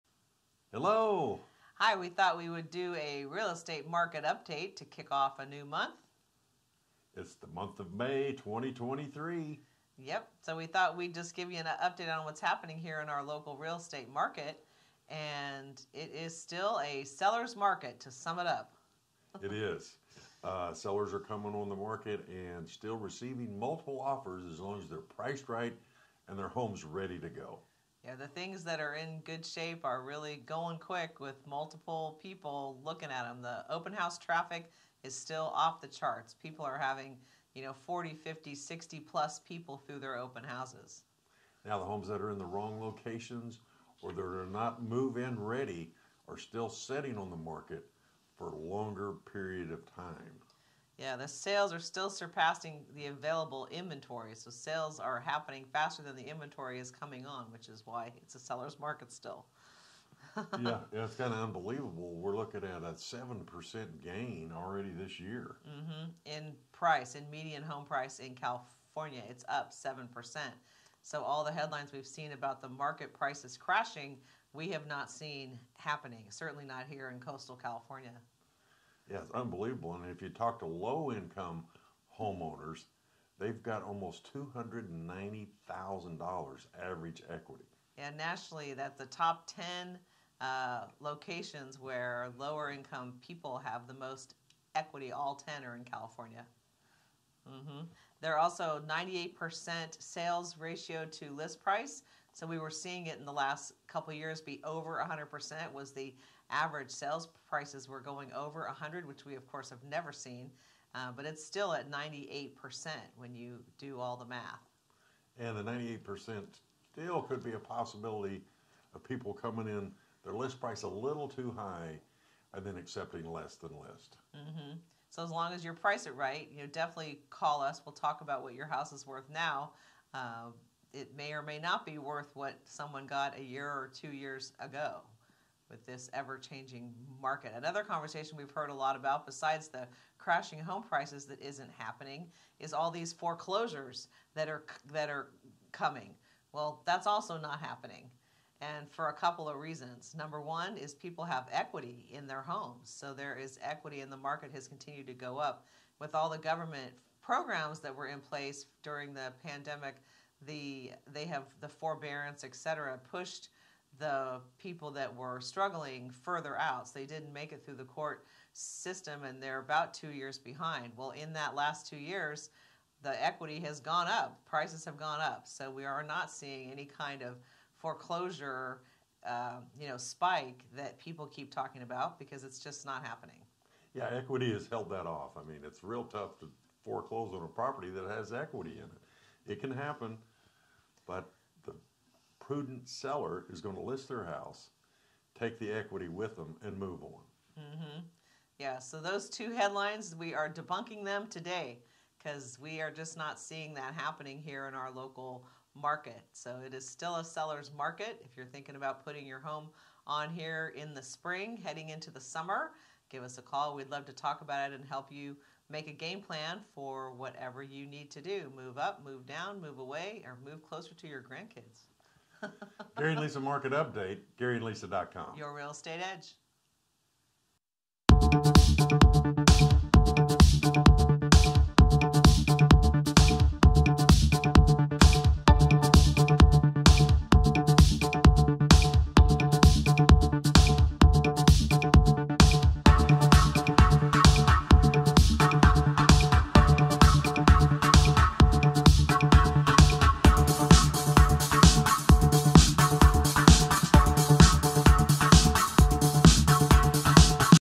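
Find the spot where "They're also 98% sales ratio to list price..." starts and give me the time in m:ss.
1:38.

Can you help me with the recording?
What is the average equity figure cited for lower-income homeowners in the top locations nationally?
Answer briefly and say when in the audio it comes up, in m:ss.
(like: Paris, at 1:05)
$290,000, at 1:24.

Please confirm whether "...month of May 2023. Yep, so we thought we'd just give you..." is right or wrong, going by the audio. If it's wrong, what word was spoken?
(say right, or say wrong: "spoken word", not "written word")
right.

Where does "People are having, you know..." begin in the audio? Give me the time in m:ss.
0:36.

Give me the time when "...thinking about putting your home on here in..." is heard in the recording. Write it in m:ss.
3:28.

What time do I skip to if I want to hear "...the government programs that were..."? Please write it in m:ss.
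2:36.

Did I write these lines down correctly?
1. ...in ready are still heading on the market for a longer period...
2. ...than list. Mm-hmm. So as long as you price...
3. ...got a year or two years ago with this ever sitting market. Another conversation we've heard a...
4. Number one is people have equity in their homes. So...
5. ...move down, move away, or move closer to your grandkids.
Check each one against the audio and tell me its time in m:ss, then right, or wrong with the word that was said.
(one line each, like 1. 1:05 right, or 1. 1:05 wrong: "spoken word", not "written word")
1. 0:45 wrong: "sitting", not "heading"
2. 2:03 right
3. 2:13 wrong: "changing", not "sitting"
4. 2:30 right
5. 3:39 right.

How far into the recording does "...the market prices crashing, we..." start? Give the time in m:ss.
1:12.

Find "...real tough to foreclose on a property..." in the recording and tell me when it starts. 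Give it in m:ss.
3:05.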